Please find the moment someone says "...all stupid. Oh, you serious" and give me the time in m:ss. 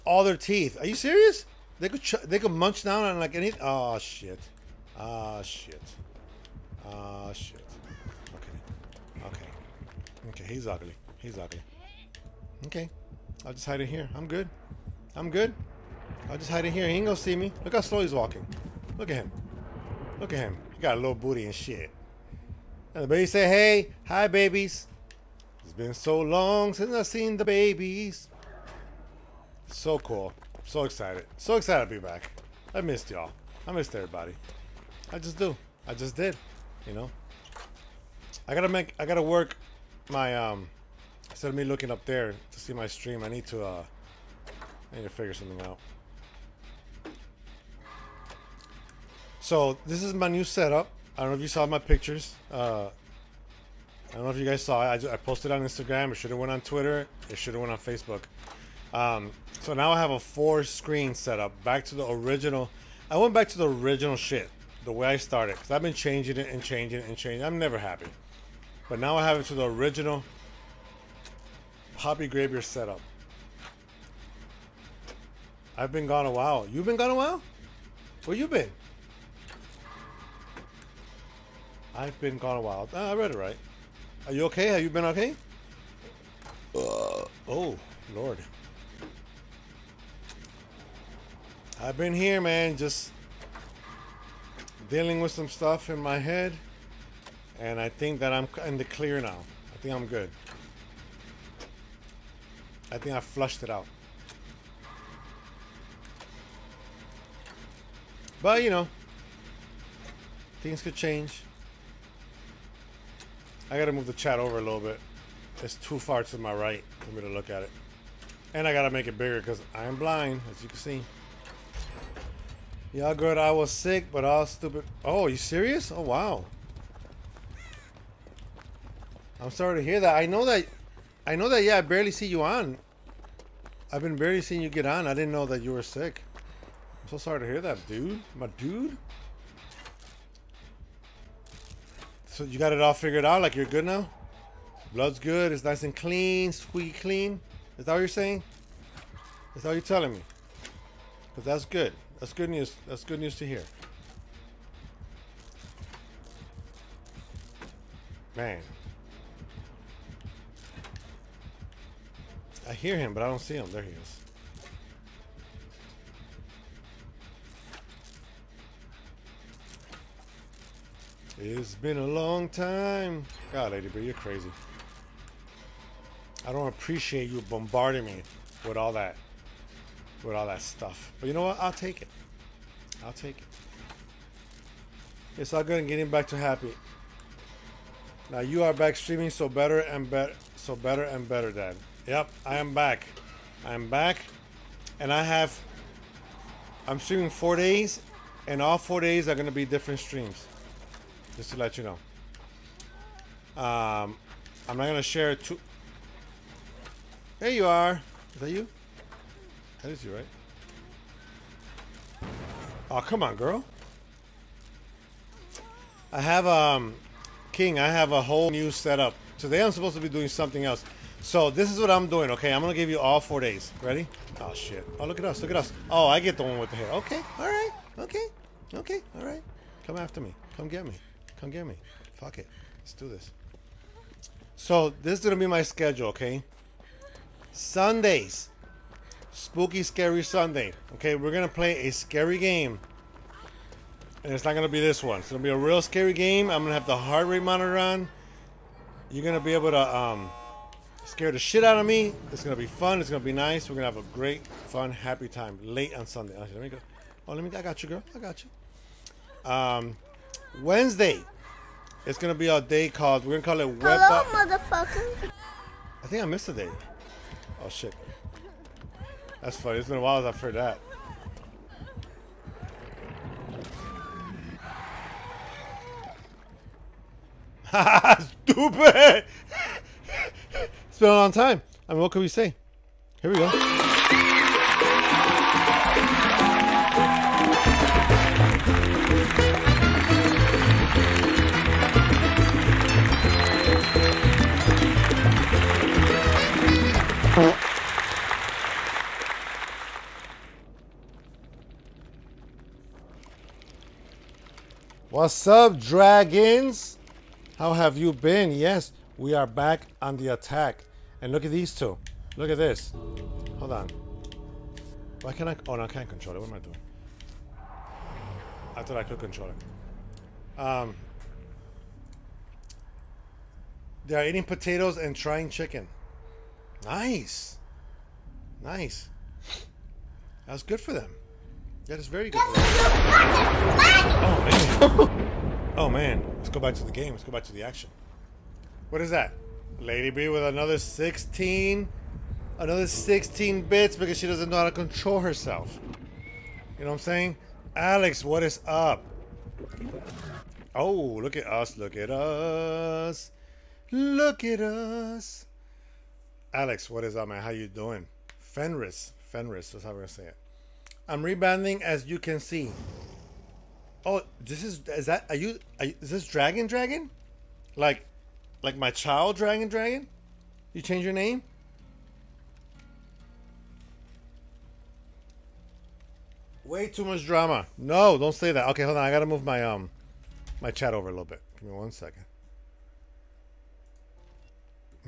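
2:04.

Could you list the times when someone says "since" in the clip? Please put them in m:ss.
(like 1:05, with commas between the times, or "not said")
0:26, 4:30.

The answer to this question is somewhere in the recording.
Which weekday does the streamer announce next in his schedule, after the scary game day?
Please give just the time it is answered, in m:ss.
4:20.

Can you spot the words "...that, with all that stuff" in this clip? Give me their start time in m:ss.
2:58.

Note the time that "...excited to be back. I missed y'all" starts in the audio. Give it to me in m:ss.
0:31.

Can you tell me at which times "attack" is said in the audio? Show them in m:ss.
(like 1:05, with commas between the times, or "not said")
5:10.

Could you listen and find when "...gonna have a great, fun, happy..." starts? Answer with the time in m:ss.
4:13.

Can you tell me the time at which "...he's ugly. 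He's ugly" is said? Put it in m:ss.
0:10.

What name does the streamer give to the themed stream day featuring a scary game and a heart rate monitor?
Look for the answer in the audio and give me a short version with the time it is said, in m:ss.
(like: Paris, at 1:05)
Spooky scary Sunday, at 3:59.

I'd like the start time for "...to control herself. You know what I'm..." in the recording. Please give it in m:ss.
5:44.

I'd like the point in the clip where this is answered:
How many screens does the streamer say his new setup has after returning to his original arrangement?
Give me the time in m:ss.
1:00.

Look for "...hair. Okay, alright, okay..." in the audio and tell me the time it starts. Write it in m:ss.
3:46.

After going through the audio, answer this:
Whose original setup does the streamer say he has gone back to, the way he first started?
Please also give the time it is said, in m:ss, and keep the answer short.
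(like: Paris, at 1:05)
Papi GrayBeard, at 1:11.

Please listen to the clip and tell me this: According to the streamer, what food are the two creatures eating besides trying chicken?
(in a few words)
potatoes.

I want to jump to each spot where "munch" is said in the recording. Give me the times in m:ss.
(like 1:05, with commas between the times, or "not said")
0:02.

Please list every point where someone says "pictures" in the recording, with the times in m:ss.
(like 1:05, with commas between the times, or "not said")
0:51.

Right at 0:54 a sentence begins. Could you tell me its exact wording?
I, just, I posted on Instagram.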